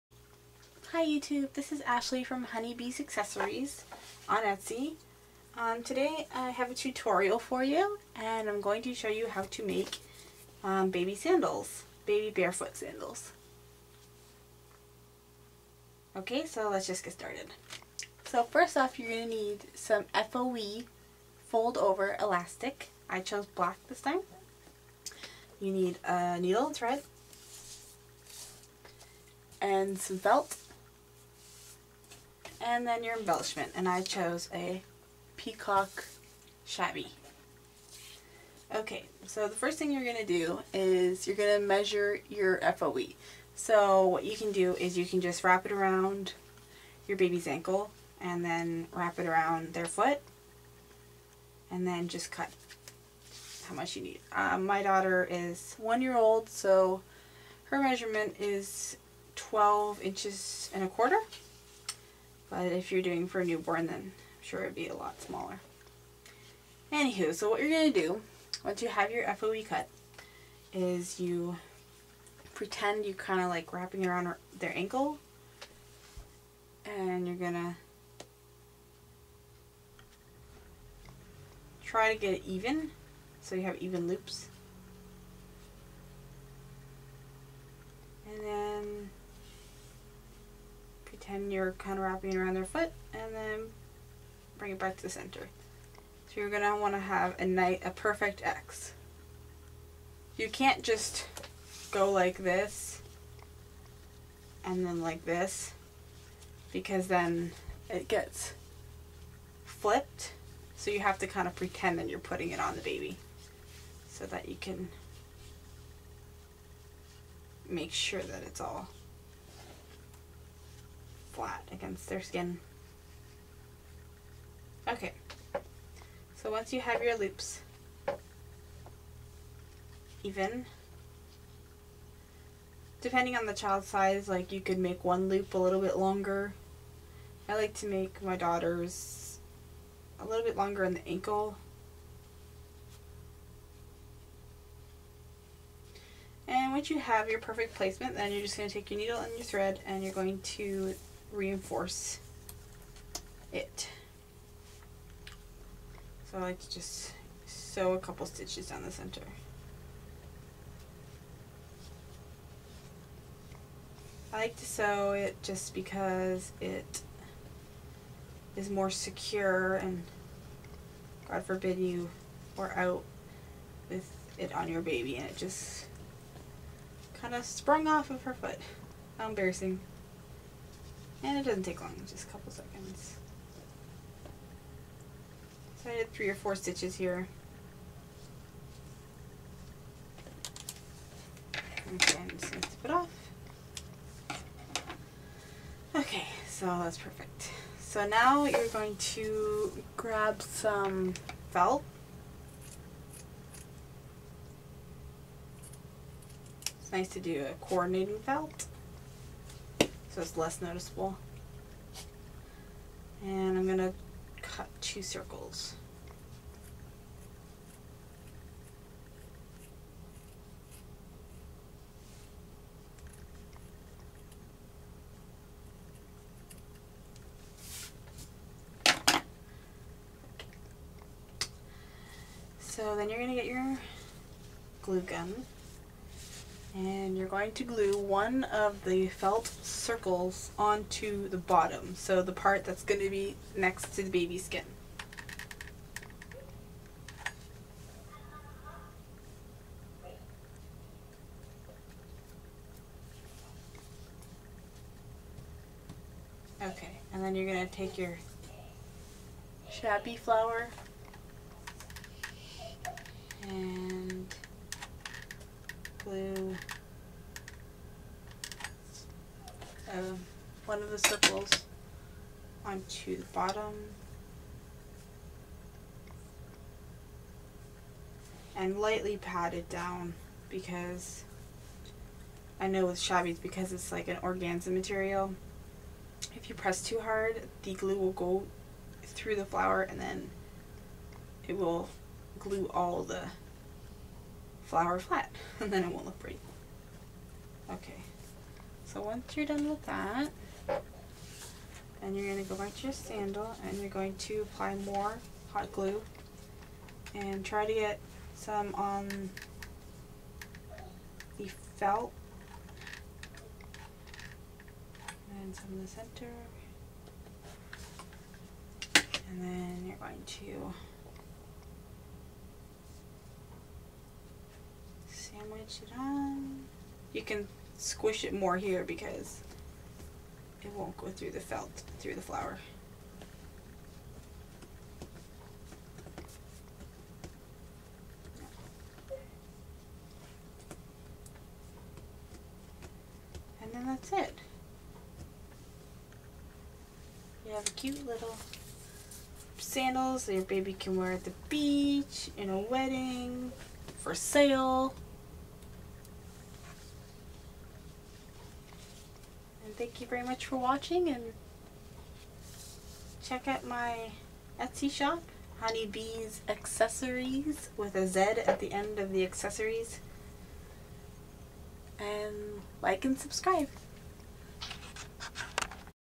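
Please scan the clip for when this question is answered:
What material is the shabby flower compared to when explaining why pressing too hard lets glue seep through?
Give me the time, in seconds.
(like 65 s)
284 s.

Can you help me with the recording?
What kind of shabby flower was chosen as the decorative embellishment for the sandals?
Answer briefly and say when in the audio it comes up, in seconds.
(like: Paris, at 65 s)
Peacock, at 35 s.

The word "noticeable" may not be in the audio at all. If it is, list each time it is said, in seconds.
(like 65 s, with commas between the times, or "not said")
210 s.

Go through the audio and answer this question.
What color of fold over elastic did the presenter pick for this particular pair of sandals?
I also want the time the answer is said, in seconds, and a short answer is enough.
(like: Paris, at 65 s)
Black, at 23 s.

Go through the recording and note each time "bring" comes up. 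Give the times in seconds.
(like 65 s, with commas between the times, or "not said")
94 s.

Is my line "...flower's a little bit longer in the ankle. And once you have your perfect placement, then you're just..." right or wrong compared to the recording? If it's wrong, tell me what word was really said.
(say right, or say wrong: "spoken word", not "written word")
wrong: "daughter", not "flower".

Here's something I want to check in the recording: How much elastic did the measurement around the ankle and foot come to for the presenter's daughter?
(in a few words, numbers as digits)
12 1/4 inches.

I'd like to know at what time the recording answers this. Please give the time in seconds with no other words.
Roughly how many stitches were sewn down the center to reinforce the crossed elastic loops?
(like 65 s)
186 s.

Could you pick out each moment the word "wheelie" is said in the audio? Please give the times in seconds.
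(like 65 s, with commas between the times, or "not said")
not said.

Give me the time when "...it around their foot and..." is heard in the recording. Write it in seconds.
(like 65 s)
49 s.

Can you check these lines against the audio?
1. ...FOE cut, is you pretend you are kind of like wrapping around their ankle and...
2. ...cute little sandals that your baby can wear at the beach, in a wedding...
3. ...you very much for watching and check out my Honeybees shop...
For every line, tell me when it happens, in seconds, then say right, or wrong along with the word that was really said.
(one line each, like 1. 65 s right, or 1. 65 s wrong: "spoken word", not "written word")
1. 69 s right
2. 347 s right
3. 360 s wrong: "Etsy", not "Honeybees".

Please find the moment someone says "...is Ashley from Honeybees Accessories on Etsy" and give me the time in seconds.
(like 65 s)
1 s.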